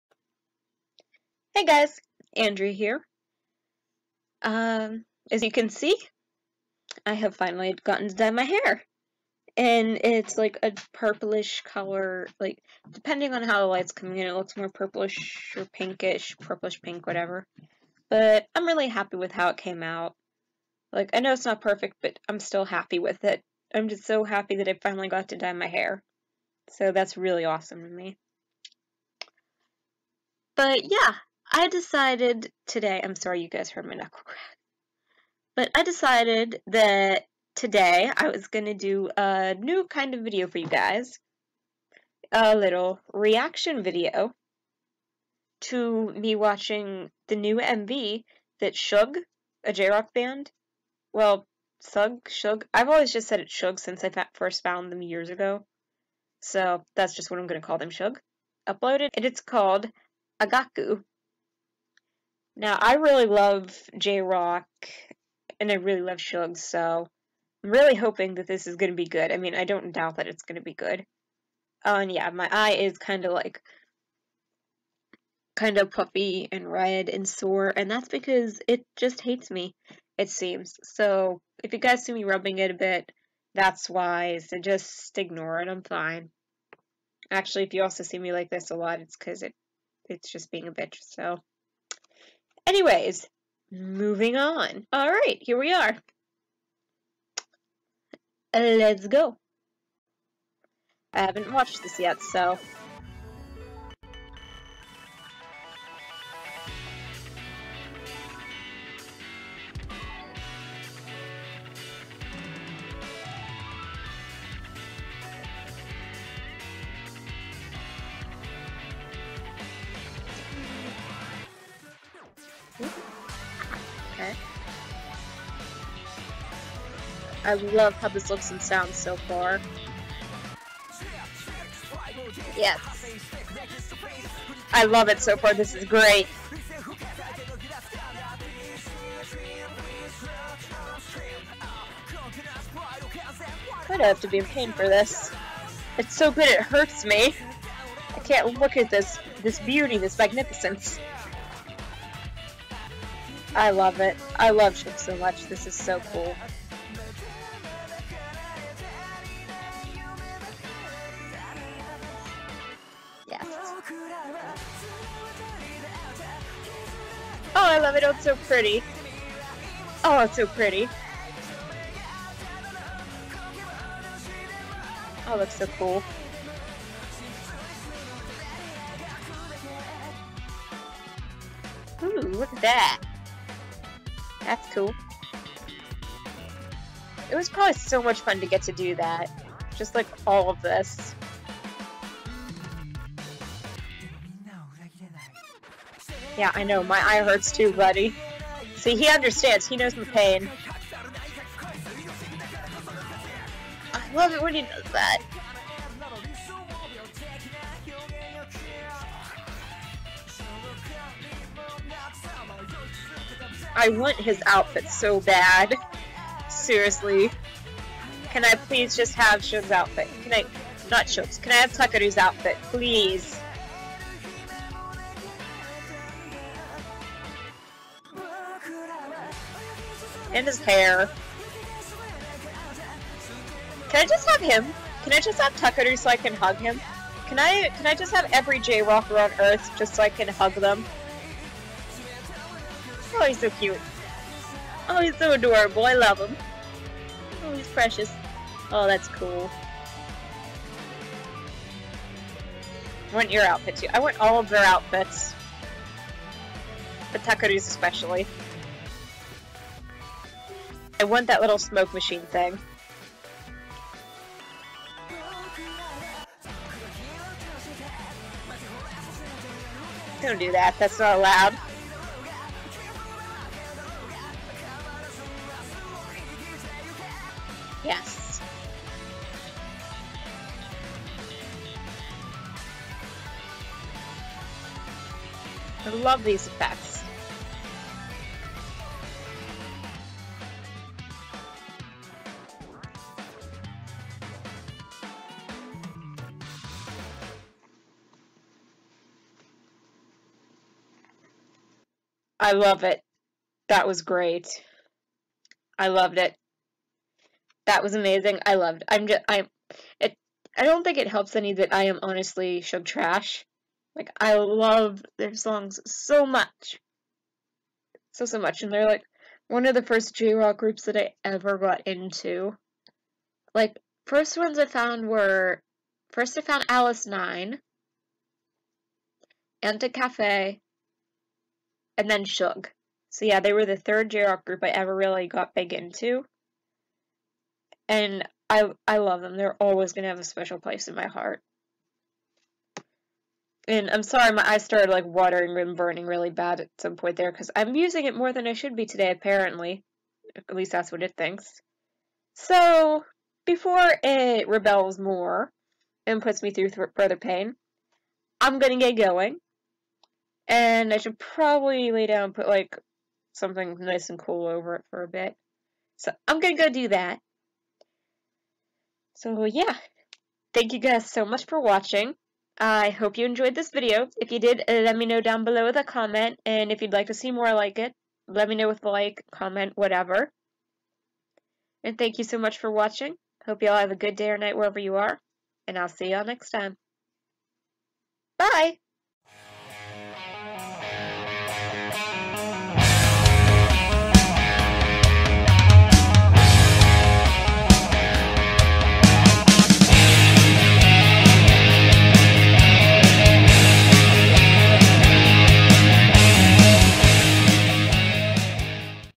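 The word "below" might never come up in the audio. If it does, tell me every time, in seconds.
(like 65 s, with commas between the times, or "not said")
375 s.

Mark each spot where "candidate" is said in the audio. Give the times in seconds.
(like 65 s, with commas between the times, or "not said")
not said.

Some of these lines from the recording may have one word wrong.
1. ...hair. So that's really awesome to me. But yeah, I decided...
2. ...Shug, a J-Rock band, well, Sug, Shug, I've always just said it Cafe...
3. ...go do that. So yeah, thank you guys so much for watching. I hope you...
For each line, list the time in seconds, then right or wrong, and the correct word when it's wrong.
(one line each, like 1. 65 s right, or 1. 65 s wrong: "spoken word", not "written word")
1. 25 s right
2. 48 s wrong: "Shug", not "Cafe"
3. 366 s right.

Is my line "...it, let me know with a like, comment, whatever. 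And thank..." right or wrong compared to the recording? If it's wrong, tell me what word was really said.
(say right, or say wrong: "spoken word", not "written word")
right.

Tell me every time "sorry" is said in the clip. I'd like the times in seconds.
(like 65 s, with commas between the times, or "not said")
33 s, 344 s.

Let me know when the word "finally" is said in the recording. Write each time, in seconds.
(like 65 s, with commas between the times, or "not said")
7 s, 24 s.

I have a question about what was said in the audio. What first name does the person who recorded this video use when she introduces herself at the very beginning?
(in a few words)
Andrea.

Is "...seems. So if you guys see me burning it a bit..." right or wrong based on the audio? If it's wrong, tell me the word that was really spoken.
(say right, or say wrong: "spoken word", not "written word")
wrong: "rubbing", not "burning".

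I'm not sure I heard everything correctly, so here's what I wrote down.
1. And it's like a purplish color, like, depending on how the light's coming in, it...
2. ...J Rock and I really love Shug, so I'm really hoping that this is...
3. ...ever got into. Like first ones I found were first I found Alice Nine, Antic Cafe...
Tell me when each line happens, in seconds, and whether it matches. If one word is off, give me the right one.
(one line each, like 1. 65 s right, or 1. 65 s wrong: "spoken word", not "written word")
1. 9 s right
2. 63 s right
3. 321 s right.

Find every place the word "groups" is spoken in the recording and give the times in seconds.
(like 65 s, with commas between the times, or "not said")
320 s, 334 s.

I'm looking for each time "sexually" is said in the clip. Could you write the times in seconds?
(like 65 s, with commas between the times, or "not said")
not said.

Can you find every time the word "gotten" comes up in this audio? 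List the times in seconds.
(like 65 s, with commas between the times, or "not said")
7 s.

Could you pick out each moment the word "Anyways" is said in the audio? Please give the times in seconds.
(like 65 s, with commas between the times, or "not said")
92 s.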